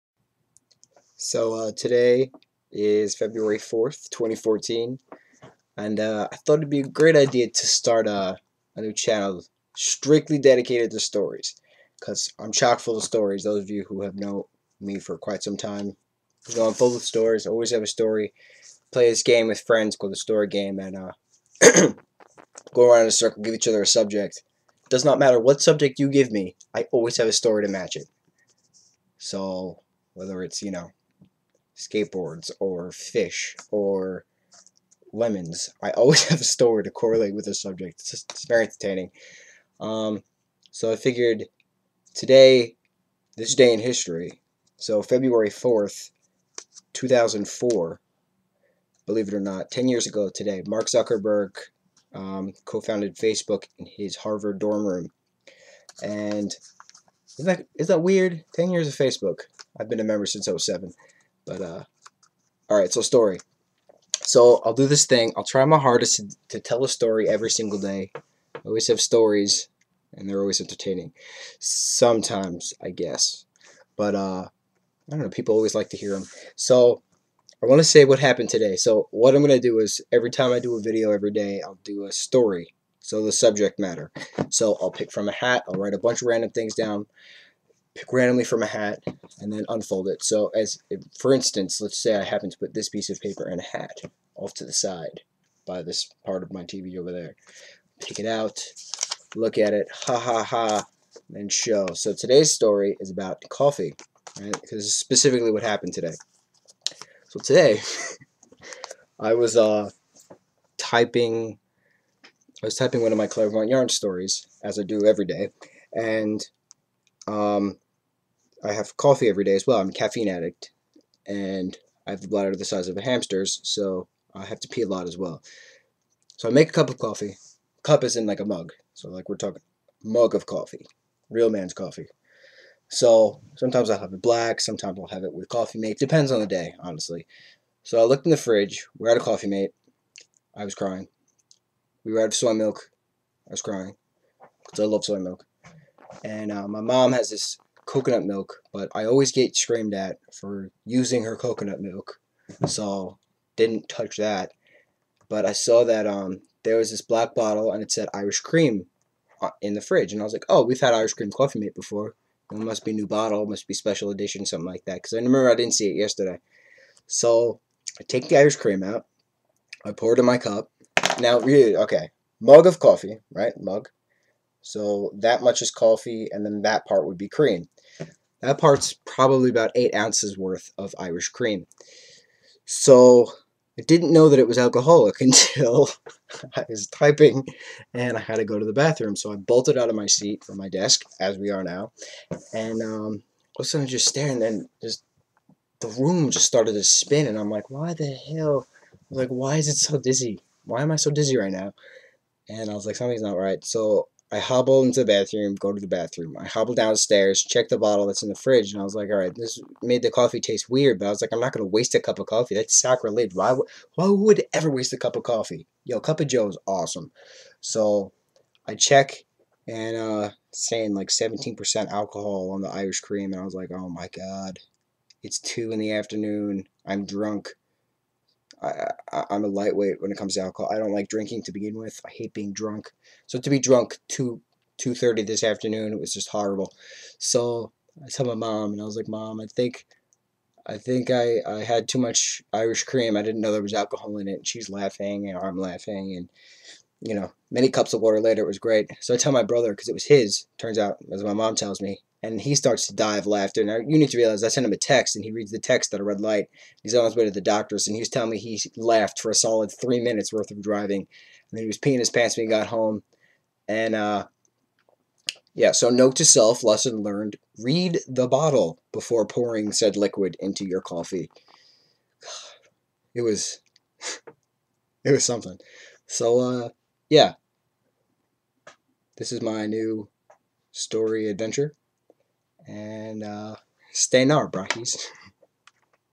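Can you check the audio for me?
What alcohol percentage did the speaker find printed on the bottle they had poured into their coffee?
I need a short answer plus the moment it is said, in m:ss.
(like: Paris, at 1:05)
17%, at 3:41.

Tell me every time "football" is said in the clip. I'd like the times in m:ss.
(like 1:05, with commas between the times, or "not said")
not said.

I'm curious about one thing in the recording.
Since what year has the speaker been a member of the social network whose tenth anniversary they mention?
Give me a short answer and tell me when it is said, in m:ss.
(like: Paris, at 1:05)
2007, at 1:00.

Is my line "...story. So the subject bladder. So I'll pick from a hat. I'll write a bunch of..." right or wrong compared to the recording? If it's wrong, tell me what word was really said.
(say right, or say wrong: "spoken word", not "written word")
wrong: "matter", not "bladder".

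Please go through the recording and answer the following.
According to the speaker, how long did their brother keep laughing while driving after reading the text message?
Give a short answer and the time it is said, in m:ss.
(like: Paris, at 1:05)
three minutes, at 4:19.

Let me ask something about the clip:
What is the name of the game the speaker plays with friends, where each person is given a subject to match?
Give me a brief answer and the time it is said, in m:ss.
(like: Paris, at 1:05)
the story game, at 0:20.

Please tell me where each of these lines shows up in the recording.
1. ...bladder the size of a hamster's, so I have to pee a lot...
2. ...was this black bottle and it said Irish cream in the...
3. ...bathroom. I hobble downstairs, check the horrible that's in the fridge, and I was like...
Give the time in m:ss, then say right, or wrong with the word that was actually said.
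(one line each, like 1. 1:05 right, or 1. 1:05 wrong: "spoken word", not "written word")
1. 2:02 right
2. 2:36 right
3. 3:25 wrong: "bottle", not "horrible".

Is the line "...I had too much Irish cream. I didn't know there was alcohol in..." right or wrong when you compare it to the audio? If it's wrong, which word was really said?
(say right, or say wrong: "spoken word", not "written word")
right.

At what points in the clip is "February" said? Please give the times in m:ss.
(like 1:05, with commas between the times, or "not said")
0:03, 0:45.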